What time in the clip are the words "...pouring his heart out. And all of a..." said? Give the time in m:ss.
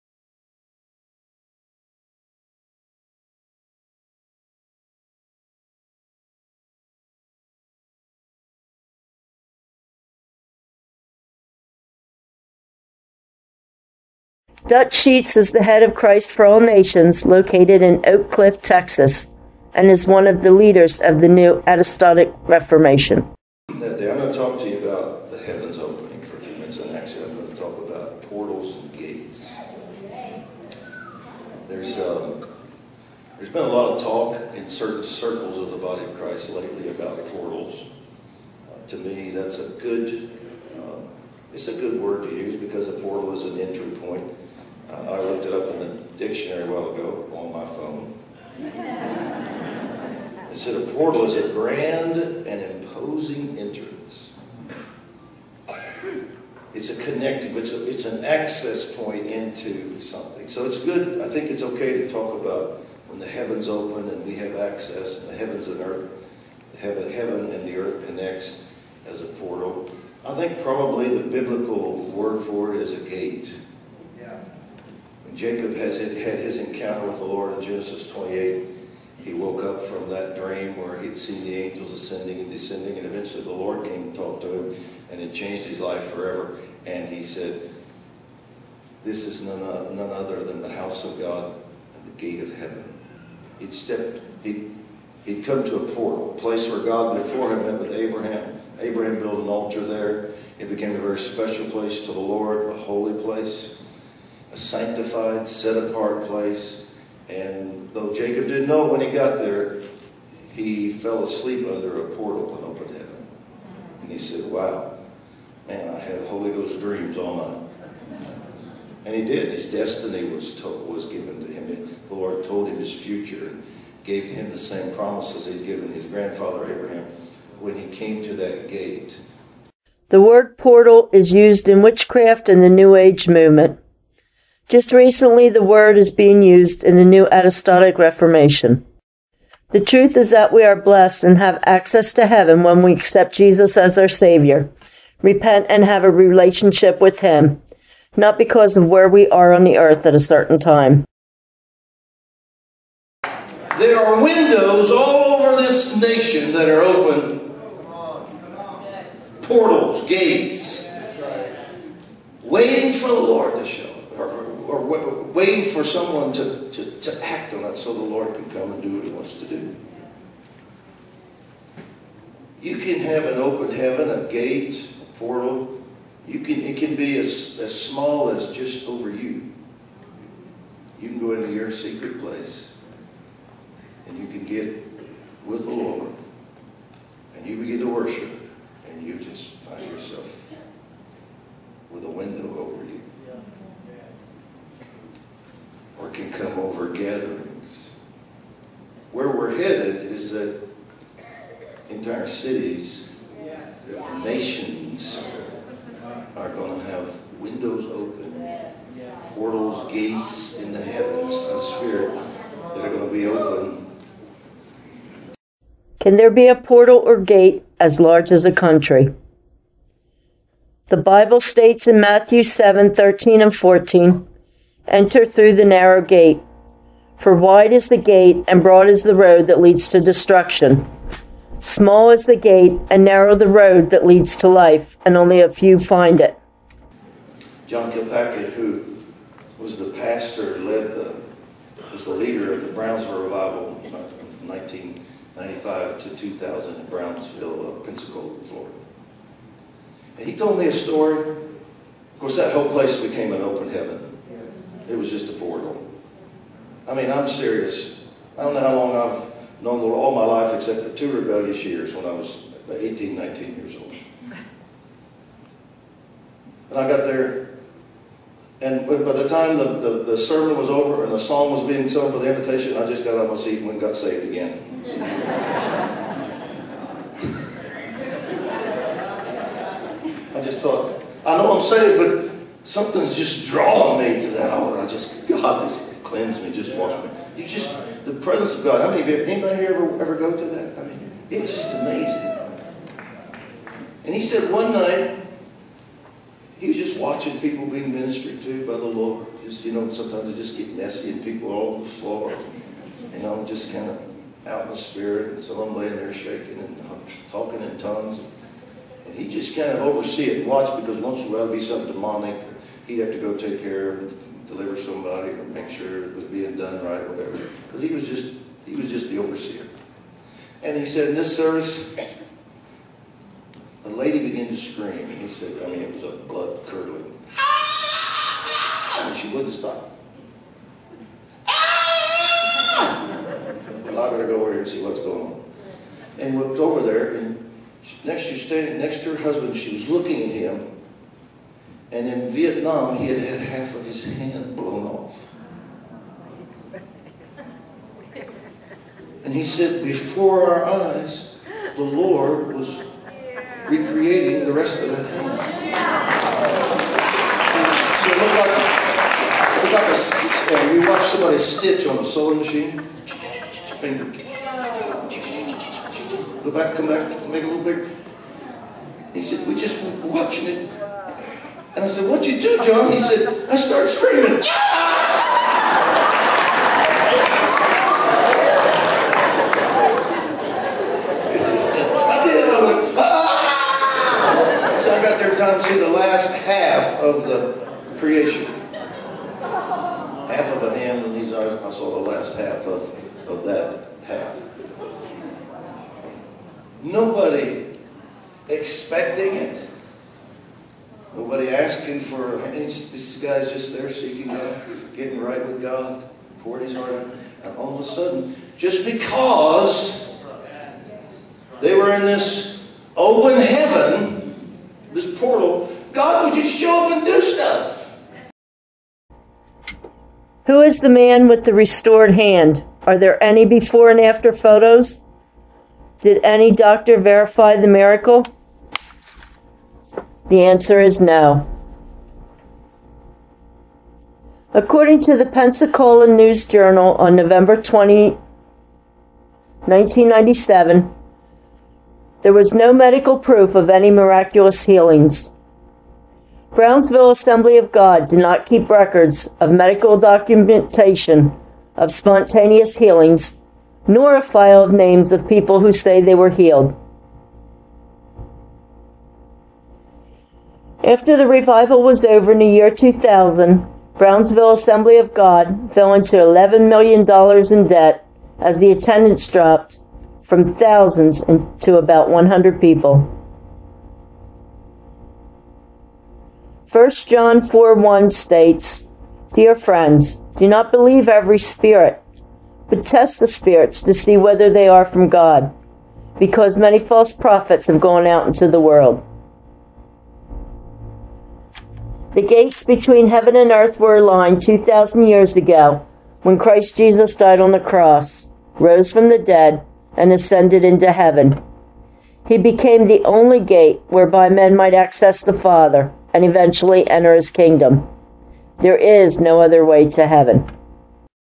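6:46.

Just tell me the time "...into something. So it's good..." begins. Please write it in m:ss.
0:59.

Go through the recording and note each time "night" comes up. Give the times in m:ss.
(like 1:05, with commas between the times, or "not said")
1:58, 4:54.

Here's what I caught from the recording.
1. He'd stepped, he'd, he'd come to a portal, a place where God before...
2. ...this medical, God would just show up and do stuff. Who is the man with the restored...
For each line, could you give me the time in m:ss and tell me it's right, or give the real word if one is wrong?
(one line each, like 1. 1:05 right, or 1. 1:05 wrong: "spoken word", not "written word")
1. 1:33 right
2. 6:54 wrong: "portal", not "medical".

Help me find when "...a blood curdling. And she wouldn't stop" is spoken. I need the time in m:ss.
5:26.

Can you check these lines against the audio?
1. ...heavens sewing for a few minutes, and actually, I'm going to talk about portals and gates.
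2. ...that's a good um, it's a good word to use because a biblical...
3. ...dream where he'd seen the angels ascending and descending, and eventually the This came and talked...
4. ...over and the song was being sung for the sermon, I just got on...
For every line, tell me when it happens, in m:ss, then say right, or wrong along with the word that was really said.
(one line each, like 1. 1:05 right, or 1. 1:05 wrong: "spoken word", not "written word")
1. 0:25 wrong: "opening", not "sewing"
2. 0:39 wrong: "portal", not "biblical"
3. 1:20 wrong: "Lord", not "This"
4. 4:30 wrong: "invitation", not "sermon".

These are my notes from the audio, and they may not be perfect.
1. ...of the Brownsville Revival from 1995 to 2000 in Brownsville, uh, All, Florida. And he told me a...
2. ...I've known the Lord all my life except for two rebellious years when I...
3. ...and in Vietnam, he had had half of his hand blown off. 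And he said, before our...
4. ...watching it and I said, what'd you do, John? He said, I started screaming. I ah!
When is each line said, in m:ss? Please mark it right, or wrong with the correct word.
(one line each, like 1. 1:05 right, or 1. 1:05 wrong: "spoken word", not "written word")
1. 4:02 wrong: "Pensacola", not "All"
2. 4:18 right
3. 5:41 right
4. 6:10 right.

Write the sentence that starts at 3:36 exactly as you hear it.
Can there be a portal or gate as large as a country?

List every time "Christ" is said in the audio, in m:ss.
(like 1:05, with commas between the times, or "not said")
0:15, 0:36, 8:16.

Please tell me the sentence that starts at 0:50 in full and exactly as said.
It said a portal is a grand and imposing entrance.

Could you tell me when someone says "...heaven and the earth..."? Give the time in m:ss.
1:07.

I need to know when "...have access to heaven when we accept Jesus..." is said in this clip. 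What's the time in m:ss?
2:21.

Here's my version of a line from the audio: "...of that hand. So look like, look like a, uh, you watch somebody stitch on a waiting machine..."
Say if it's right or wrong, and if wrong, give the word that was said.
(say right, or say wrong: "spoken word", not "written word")
wrong: "sewing", not "waiting".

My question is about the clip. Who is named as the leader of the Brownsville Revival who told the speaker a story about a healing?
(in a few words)
John Kilpatrick.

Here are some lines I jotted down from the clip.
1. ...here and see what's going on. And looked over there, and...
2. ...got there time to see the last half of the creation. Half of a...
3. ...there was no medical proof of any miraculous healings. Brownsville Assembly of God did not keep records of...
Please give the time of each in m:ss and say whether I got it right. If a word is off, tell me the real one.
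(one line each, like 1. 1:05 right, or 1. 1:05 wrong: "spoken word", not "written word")
1. 5:34 right
2. 6:25 right
3. 7:22 right.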